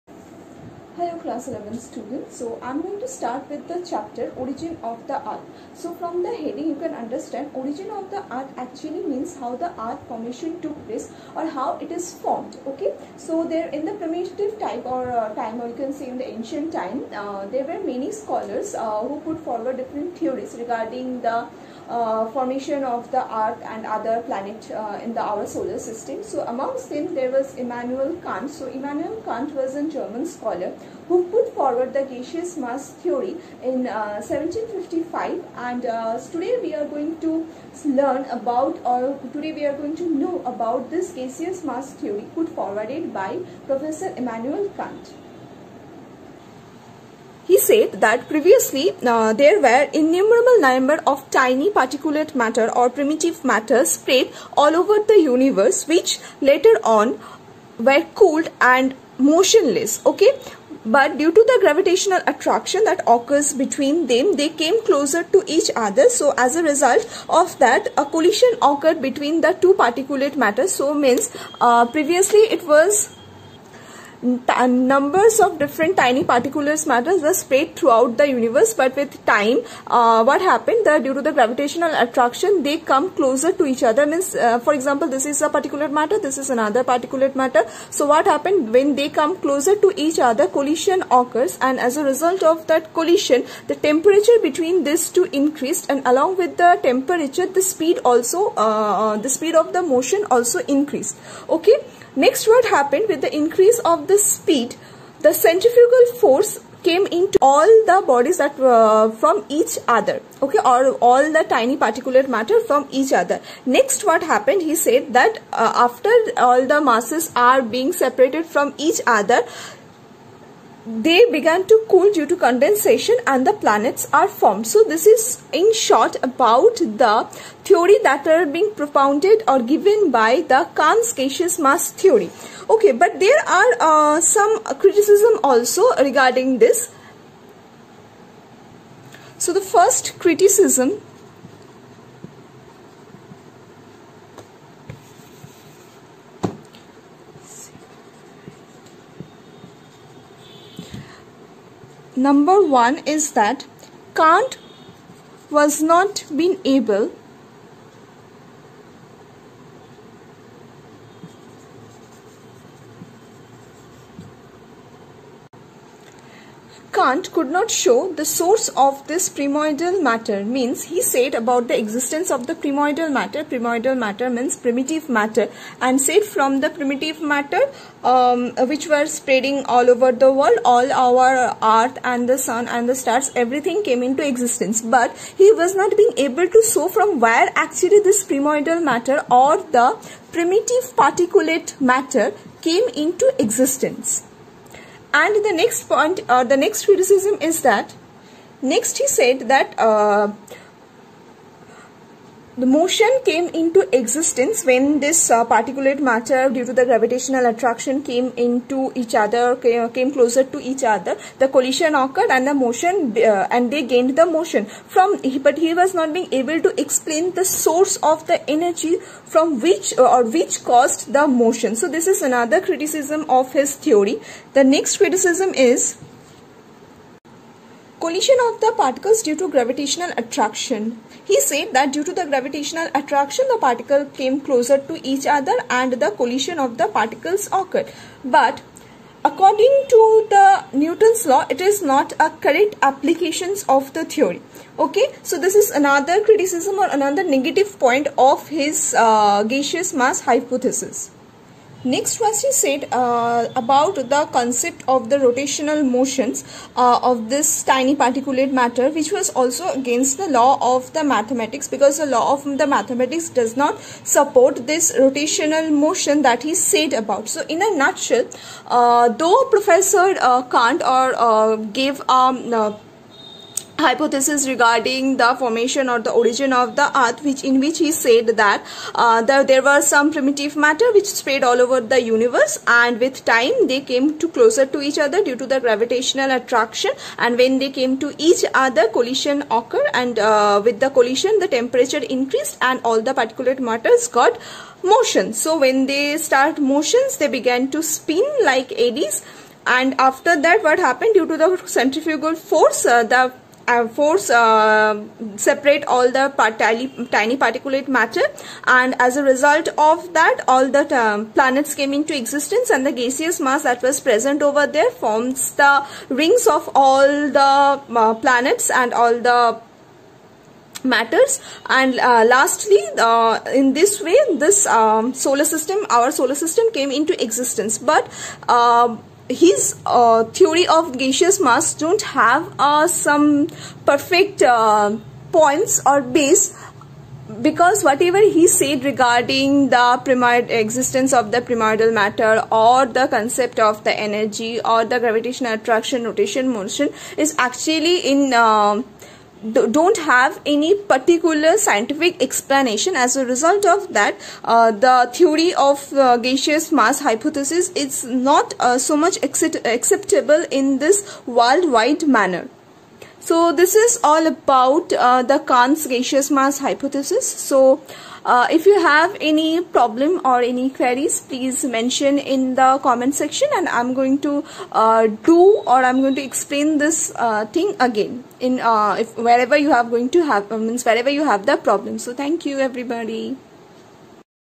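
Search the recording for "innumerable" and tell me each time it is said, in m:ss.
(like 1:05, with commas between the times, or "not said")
0:49.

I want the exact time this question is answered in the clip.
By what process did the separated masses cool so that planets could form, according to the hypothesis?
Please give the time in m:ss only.
2:02.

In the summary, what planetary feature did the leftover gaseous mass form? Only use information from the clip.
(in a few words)
Rings.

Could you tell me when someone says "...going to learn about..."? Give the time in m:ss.
0:36.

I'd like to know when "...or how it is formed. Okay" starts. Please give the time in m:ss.
0:11.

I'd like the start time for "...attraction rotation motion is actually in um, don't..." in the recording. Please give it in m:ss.
5:45.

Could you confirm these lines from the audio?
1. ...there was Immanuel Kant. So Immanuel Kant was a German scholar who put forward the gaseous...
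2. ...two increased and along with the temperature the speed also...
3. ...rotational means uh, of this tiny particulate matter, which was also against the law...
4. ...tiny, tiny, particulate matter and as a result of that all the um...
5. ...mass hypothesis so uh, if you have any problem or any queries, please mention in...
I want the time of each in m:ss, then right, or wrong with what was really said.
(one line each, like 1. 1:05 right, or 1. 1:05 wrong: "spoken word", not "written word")
1. 0:27 right
2. 1:35 right
3. 4:15 wrong: "motions", not "means"
4. 5:06 right
5. 6:06 right.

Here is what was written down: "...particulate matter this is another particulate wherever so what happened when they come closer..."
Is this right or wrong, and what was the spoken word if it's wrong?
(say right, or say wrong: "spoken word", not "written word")
wrong: "matter", not "wherever".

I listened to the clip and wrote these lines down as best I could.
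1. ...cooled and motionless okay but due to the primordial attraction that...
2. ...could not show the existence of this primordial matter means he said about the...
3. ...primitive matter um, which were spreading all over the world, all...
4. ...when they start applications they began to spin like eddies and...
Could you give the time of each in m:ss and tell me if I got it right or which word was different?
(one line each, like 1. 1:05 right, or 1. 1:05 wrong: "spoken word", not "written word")
1. 0:58 wrong: "gravitational", not "primordial"
2. 2:47 wrong: "source", not "existence"
3. 2:56 right
4. 4:55 wrong: "motions", not "applications".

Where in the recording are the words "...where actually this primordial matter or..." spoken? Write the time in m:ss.
3:07.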